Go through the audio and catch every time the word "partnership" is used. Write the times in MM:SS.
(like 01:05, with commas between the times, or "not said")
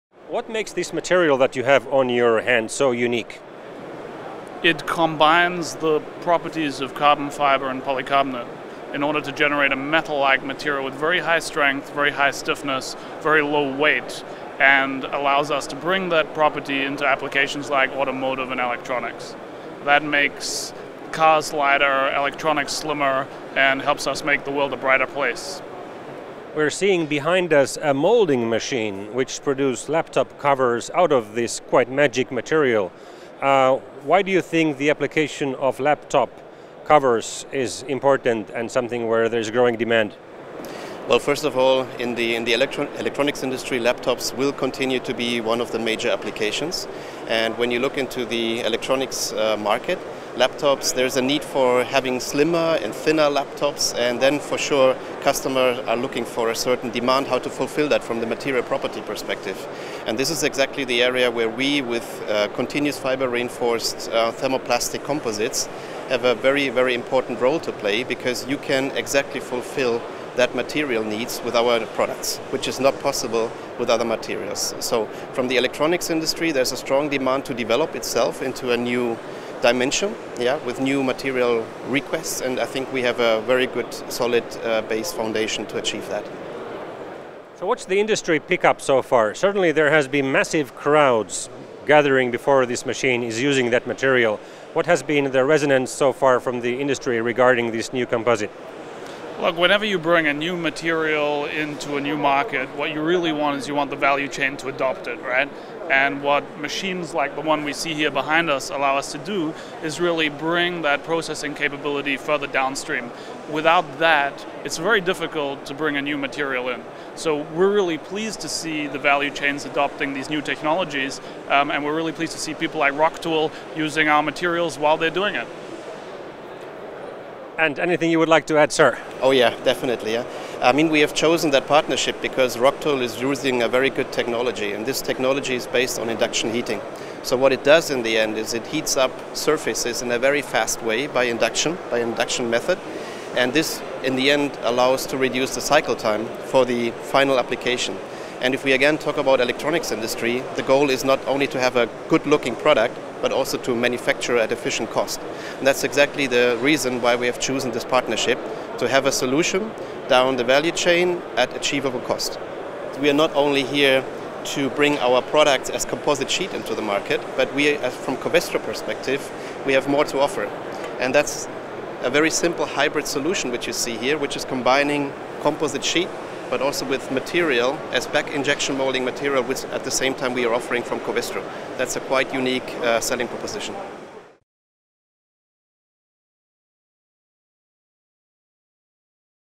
02:11, 02:37.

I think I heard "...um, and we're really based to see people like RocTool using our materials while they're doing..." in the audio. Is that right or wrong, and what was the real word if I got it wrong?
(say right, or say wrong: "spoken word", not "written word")
wrong: "pleased", not "based".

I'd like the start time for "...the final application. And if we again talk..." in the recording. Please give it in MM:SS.
02:26.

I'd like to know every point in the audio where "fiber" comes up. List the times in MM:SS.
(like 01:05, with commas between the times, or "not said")
00:07, 01:02.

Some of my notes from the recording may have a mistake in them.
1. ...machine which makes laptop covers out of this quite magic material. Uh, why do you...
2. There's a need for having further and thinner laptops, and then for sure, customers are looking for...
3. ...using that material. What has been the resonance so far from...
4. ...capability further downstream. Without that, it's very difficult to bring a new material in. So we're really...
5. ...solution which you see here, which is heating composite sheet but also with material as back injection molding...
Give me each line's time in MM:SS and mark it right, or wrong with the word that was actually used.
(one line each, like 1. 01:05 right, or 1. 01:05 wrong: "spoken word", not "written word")
1. 00:28 wrong: "produces", not "makes"
2. 00:50 wrong: "slimmer", not "further"
3. 01:33 right
4. 01:51 right
5. 02:53 wrong: "combining", not "heating".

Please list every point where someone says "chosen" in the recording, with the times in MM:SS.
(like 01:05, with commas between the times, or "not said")
02:11, 02:37.